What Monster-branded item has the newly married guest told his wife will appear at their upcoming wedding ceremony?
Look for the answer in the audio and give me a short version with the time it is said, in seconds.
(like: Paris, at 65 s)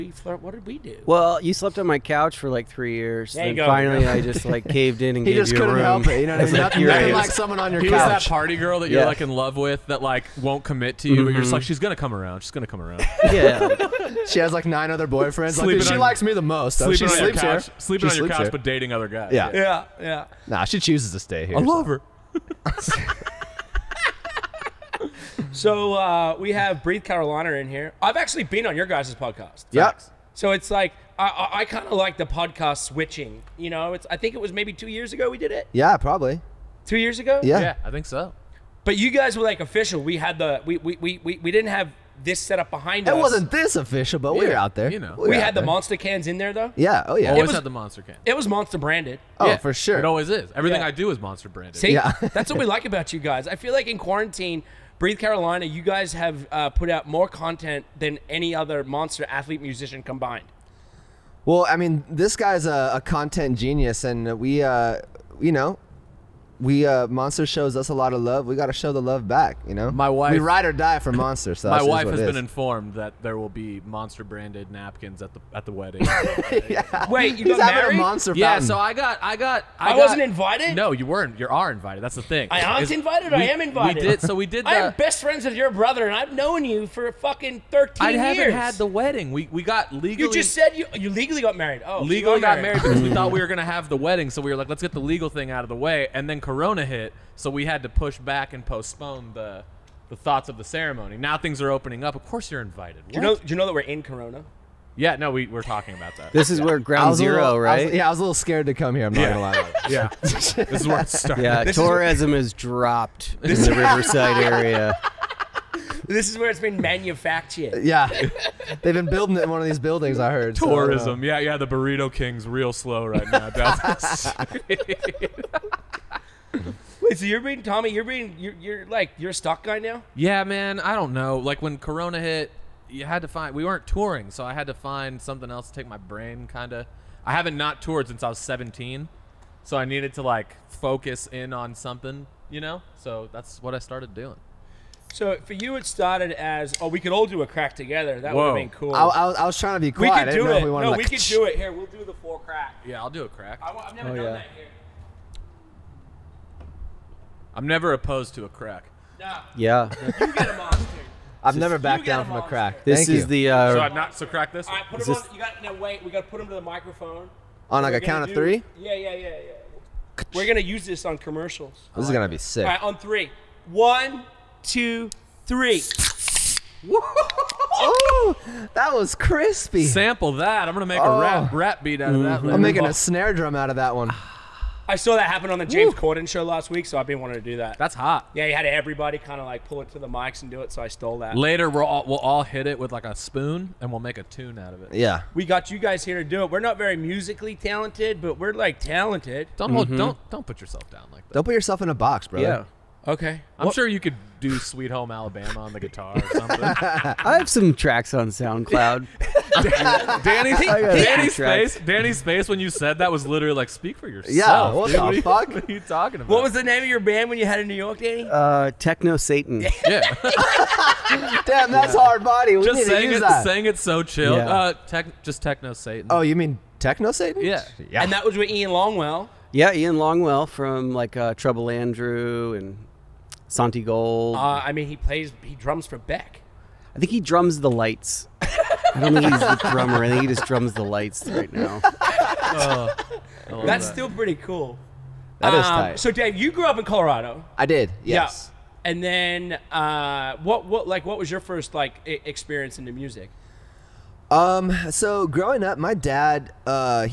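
Napkins, at 74 s.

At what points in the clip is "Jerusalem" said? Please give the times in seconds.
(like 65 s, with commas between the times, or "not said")
not said.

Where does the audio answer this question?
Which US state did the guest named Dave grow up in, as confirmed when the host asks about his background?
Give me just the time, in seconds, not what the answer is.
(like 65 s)
246 s.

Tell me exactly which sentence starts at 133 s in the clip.
We weren't touring, so I had to find something else to take my brain.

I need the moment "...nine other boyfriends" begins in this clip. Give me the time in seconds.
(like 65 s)
14 s.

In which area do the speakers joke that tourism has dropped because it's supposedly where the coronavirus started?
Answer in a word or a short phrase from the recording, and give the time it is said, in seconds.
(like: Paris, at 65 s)
Riverside, at 113 s.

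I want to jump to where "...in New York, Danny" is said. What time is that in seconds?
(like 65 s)
217 s.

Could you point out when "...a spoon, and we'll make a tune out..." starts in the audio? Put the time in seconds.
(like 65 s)
193 s.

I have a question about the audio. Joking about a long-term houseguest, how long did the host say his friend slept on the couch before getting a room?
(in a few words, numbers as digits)
3 years.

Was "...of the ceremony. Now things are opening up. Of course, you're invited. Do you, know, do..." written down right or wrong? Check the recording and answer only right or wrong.
right.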